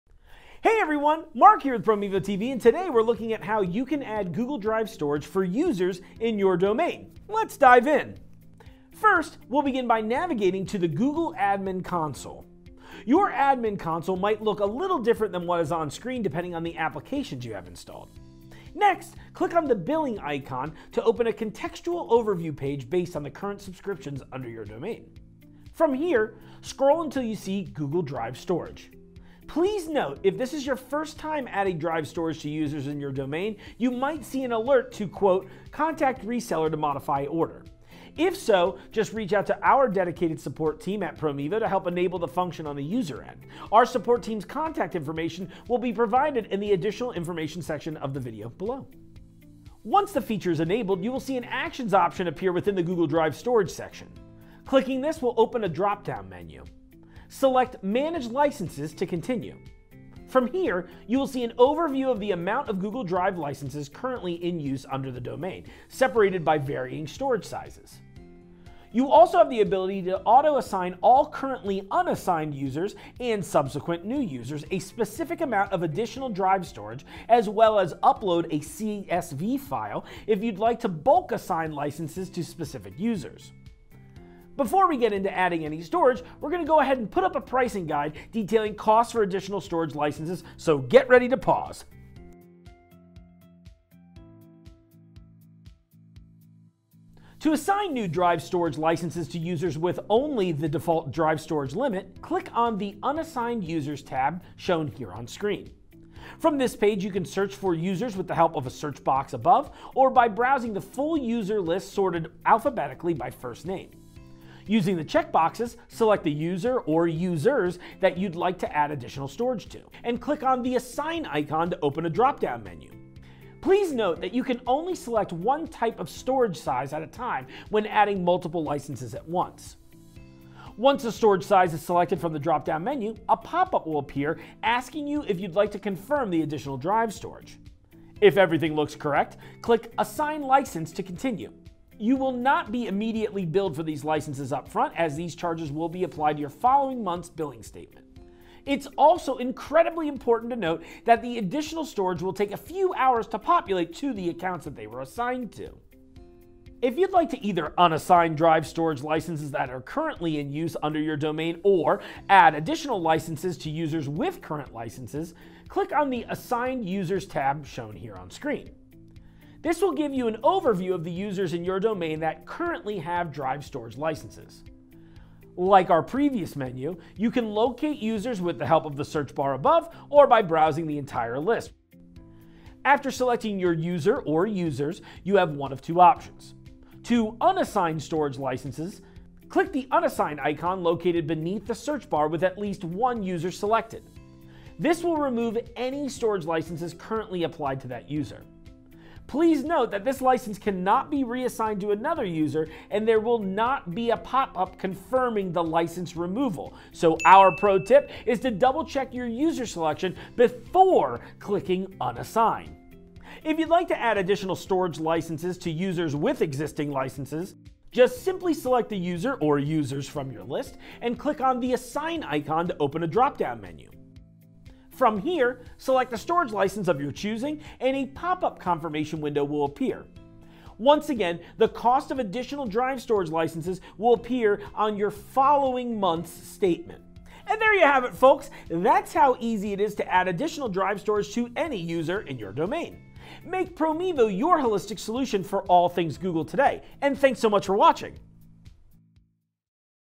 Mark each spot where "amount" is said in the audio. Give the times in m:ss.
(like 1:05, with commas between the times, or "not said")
1:02, 1:15.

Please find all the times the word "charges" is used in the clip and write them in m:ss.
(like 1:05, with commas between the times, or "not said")
2:25.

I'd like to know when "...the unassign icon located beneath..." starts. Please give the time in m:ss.
3:09.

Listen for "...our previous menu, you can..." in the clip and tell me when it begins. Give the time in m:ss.
2:55.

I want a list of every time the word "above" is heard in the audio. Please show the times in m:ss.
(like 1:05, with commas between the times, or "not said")
1:49, 2:59.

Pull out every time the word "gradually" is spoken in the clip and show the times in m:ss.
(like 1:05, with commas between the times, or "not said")
not said.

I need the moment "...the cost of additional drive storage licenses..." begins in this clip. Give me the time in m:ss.
3:51.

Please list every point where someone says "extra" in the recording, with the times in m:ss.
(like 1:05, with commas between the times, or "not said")
not said.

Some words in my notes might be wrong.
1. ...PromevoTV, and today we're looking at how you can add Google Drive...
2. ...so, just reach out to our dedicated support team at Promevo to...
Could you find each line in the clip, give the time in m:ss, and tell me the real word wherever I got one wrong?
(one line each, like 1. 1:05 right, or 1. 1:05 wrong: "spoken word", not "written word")
1. 0:01 right
2. 0:38 right.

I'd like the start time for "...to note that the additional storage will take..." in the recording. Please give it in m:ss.
2:30.